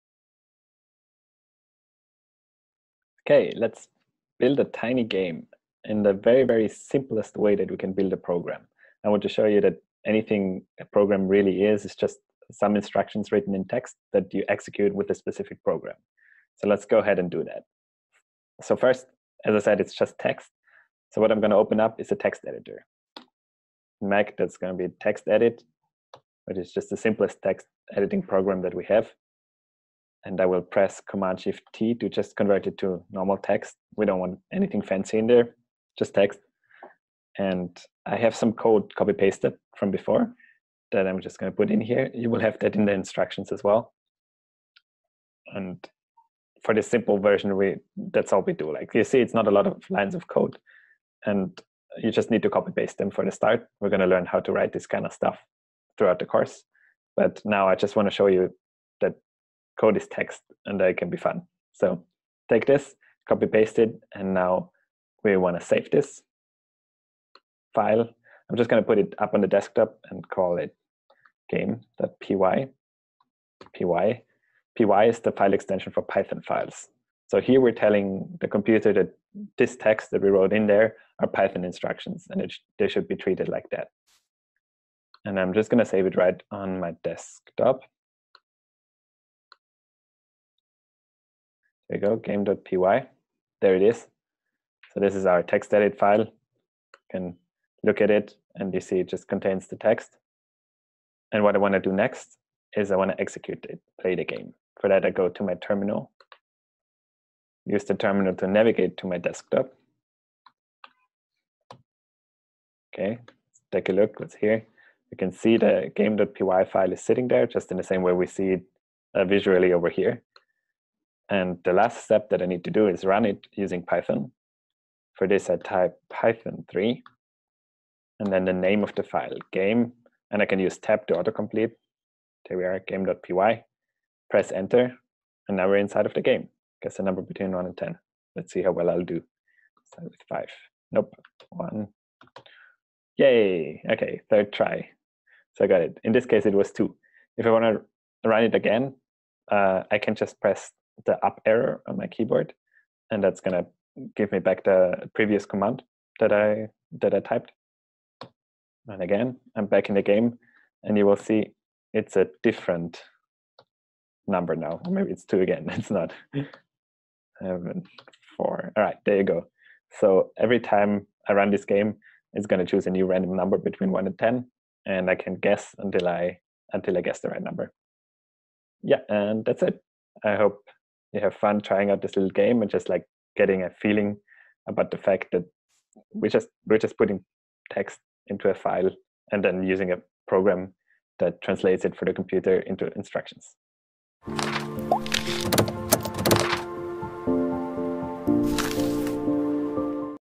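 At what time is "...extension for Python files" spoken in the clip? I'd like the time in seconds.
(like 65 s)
75 s.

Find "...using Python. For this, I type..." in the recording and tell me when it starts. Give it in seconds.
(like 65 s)
123 s.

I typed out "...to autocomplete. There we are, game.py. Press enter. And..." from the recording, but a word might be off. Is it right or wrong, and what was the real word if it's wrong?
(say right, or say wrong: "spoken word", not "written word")
right.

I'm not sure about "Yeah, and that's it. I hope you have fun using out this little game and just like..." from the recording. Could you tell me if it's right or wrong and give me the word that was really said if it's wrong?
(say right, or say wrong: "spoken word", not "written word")
wrong: "trying", not "using".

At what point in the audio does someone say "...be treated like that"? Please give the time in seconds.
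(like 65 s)
83 s.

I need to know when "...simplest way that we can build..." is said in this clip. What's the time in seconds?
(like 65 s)
6 s.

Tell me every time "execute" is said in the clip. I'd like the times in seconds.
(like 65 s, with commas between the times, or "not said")
14 s, 103 s.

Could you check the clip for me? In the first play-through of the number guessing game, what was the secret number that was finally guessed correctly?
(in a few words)
2.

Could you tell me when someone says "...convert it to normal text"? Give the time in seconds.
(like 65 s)
32 s.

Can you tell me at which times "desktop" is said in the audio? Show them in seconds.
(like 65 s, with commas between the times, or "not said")
69 s, 87 s, 109 s.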